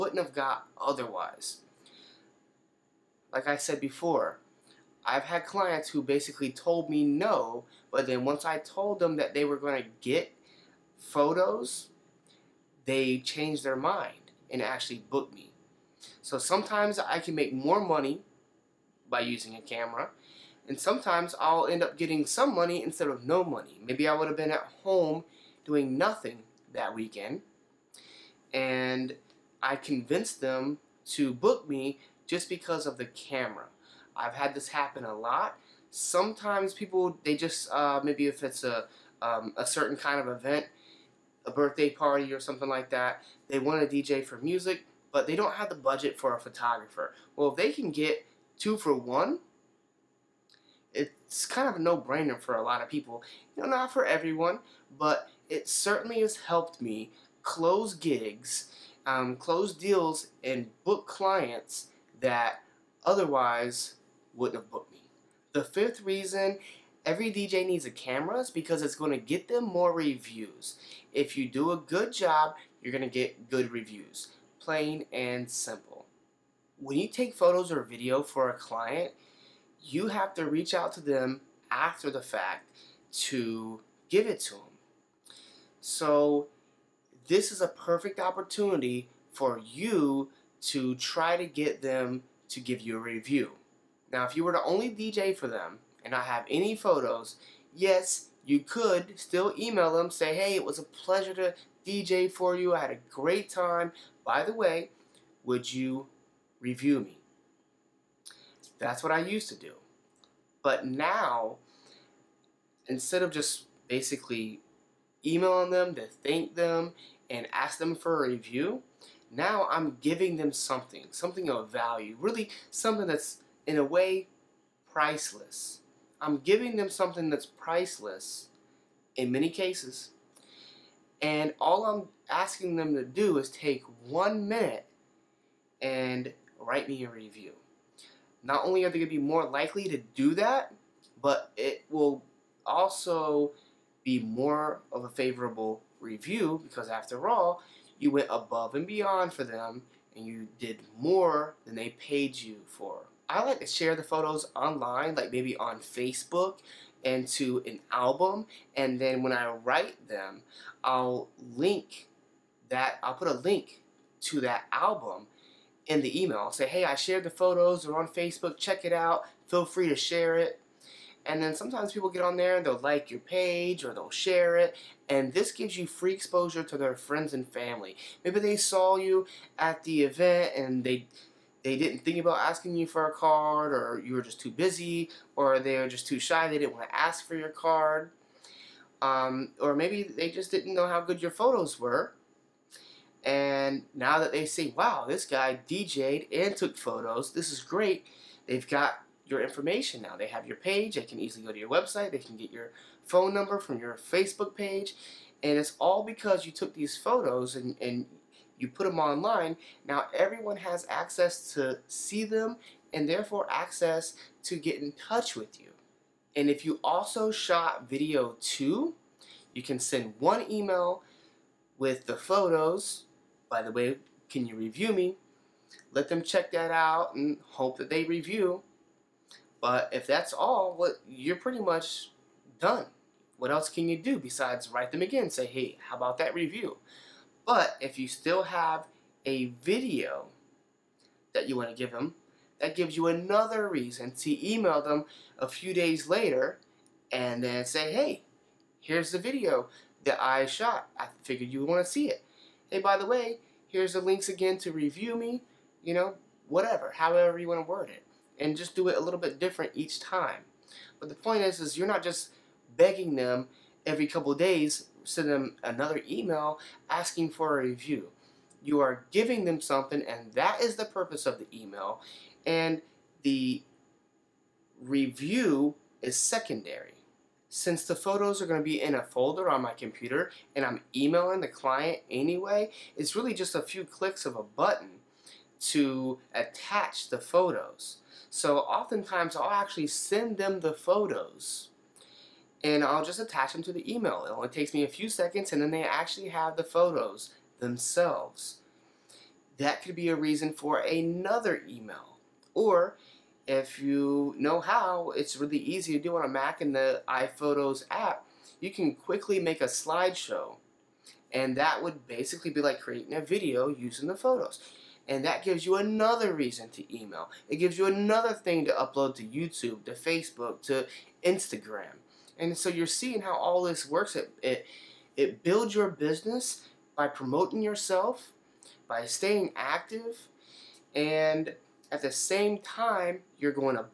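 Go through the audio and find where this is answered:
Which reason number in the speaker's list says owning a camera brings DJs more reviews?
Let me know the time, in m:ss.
1:05.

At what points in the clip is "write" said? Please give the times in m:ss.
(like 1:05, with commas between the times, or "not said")
2:16, 2:39, 3:54.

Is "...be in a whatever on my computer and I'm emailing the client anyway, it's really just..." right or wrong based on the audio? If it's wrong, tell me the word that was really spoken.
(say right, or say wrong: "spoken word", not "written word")
wrong: "folder", not "whatever".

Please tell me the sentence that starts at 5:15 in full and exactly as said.
And that gives you another reason to email.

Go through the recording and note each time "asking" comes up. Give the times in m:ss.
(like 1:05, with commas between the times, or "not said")
2:12, 3:02, 4:26.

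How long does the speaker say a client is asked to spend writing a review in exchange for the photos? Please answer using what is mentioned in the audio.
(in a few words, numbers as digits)
one minute.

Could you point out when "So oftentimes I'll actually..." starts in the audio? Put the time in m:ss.
4:48.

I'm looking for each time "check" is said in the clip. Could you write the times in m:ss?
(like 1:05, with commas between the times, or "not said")
2:48, 3:46.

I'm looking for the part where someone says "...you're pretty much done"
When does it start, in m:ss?
3:51.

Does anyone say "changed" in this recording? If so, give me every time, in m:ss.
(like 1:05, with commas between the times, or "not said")
0:13.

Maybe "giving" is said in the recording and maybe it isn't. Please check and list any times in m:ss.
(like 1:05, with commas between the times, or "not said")
2:00, 2:06, 4:29.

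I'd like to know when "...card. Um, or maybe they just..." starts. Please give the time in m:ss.
3:07.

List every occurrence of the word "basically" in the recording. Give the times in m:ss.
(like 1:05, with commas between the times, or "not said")
0:06, 1:53, 5:12.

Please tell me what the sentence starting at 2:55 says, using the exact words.
And this gives you free exposure to their friends and family.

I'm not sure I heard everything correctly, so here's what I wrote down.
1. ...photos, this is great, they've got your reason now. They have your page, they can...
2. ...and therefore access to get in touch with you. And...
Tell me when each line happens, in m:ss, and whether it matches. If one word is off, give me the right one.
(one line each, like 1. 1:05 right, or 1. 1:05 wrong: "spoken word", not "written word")
1. 3:16 wrong: "information", not "reason"
2. 3:32 right.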